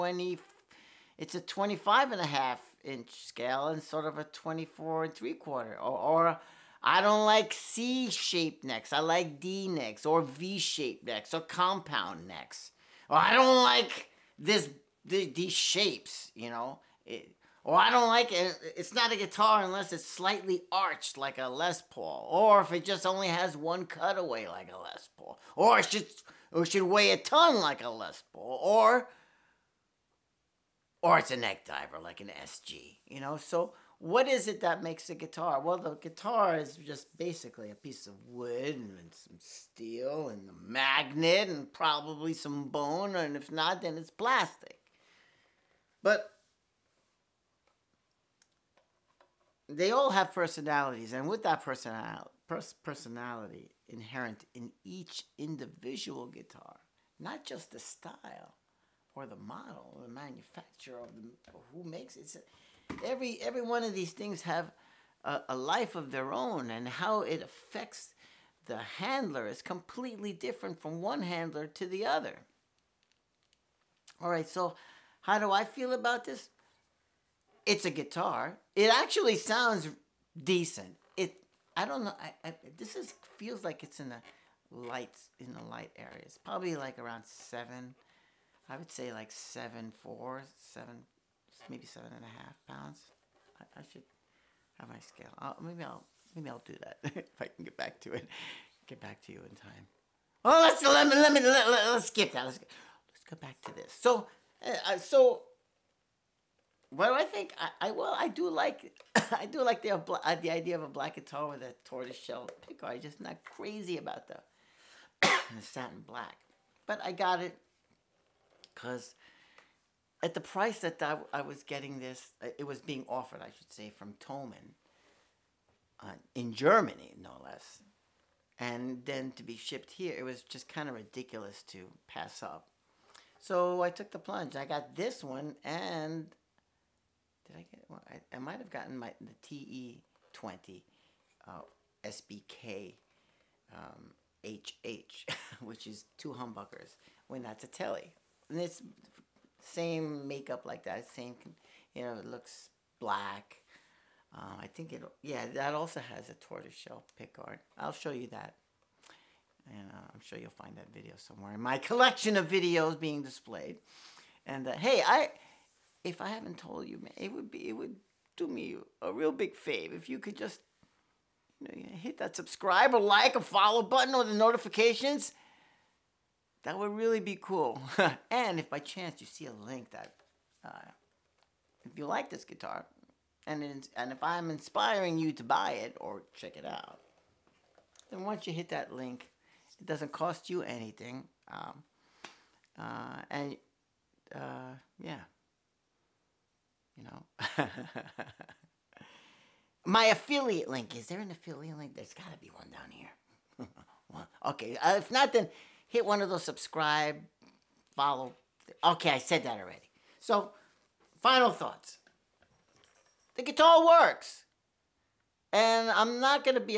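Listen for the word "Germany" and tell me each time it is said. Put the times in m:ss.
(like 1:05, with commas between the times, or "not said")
2:06.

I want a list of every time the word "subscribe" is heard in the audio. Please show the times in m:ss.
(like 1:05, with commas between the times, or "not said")
2:52, 3:26.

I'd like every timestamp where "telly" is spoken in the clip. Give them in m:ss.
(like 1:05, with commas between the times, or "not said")
2:27.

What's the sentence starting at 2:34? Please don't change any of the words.
Um, I think it, yeah, that also has a tortoiseshell pickguard.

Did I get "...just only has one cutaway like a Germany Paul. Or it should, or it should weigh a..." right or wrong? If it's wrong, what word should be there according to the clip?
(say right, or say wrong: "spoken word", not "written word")
wrong: "Les", not "Germany".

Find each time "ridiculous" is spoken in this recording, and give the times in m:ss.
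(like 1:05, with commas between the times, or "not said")
2:10.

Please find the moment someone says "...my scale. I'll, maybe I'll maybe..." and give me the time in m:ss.
1:34.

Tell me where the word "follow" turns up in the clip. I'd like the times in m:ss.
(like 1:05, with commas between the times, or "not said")
2:53, 3:27.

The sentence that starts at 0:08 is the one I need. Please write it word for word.
I like D necks or V-shaped necks or compound necks.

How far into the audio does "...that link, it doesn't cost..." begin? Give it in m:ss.
3:08.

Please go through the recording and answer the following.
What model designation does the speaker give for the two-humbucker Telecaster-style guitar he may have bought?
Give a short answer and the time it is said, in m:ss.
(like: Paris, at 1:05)
TE20 SBK HH, at 2:20.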